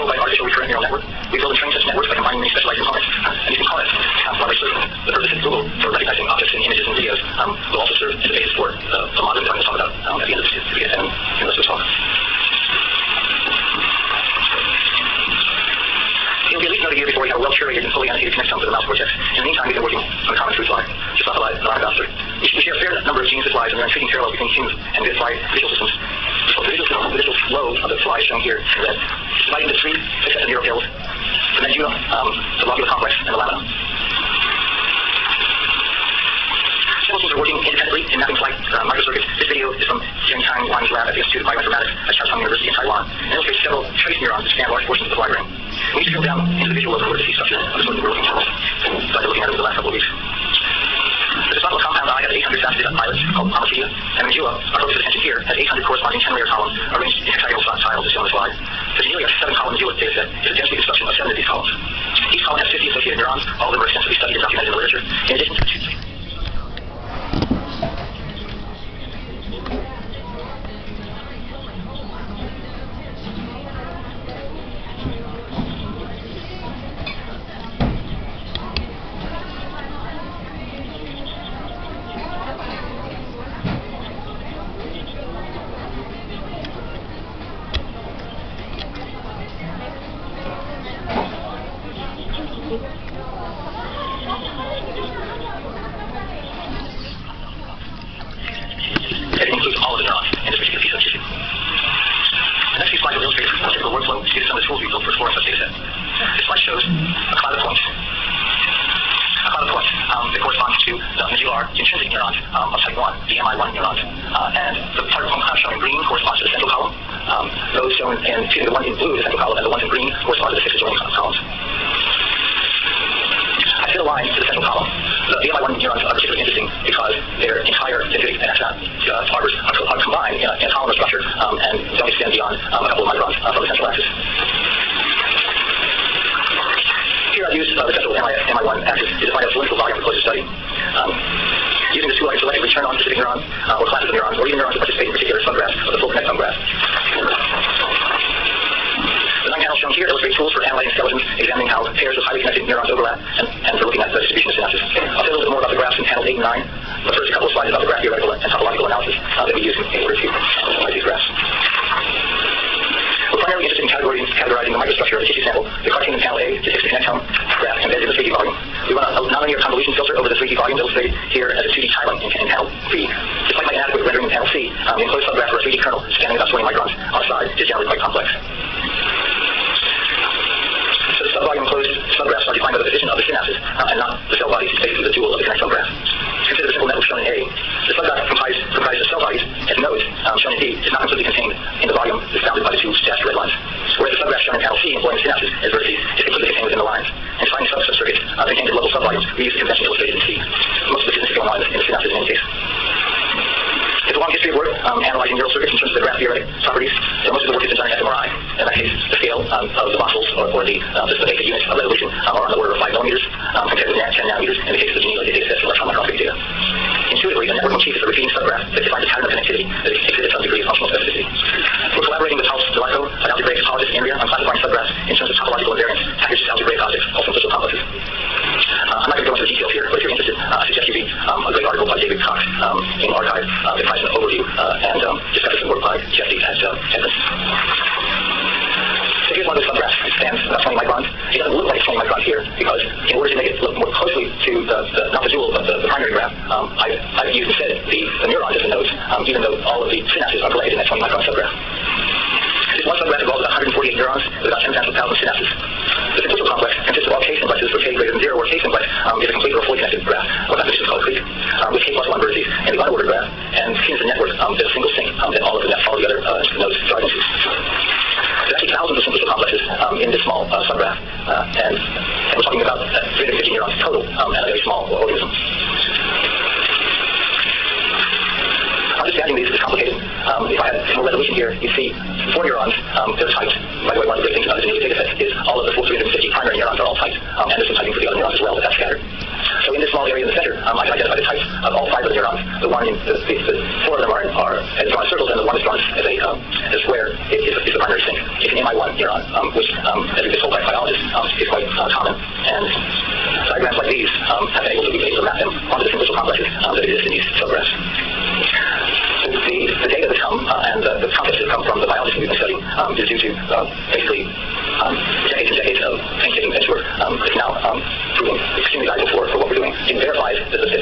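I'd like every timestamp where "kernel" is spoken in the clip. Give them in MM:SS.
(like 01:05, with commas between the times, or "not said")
02:55.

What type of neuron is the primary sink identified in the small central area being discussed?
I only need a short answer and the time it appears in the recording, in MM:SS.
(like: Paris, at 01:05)
MI1, at 04:58.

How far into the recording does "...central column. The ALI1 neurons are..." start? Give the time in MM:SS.
02:04.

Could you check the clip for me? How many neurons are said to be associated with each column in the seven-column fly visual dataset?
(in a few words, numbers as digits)
50.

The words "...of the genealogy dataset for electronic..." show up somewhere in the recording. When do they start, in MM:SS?
03:34.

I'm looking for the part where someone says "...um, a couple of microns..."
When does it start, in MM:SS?
02:12.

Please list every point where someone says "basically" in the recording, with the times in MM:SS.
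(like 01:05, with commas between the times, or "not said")
03:04, 05:13.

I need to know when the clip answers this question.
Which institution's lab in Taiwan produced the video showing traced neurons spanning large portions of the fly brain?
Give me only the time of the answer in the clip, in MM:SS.
00:41.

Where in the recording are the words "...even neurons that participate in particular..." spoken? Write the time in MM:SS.
02:24.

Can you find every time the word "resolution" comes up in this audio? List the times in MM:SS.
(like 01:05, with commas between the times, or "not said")
03:31, 04:41.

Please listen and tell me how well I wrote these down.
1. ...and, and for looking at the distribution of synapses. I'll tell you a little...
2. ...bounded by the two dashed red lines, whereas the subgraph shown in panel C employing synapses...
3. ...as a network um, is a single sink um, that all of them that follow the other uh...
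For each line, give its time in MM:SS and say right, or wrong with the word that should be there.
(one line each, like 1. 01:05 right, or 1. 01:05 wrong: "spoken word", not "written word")
1. 02:33 right
2. 03:12 right
3. 04:24 right.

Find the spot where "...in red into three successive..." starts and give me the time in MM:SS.
00:28.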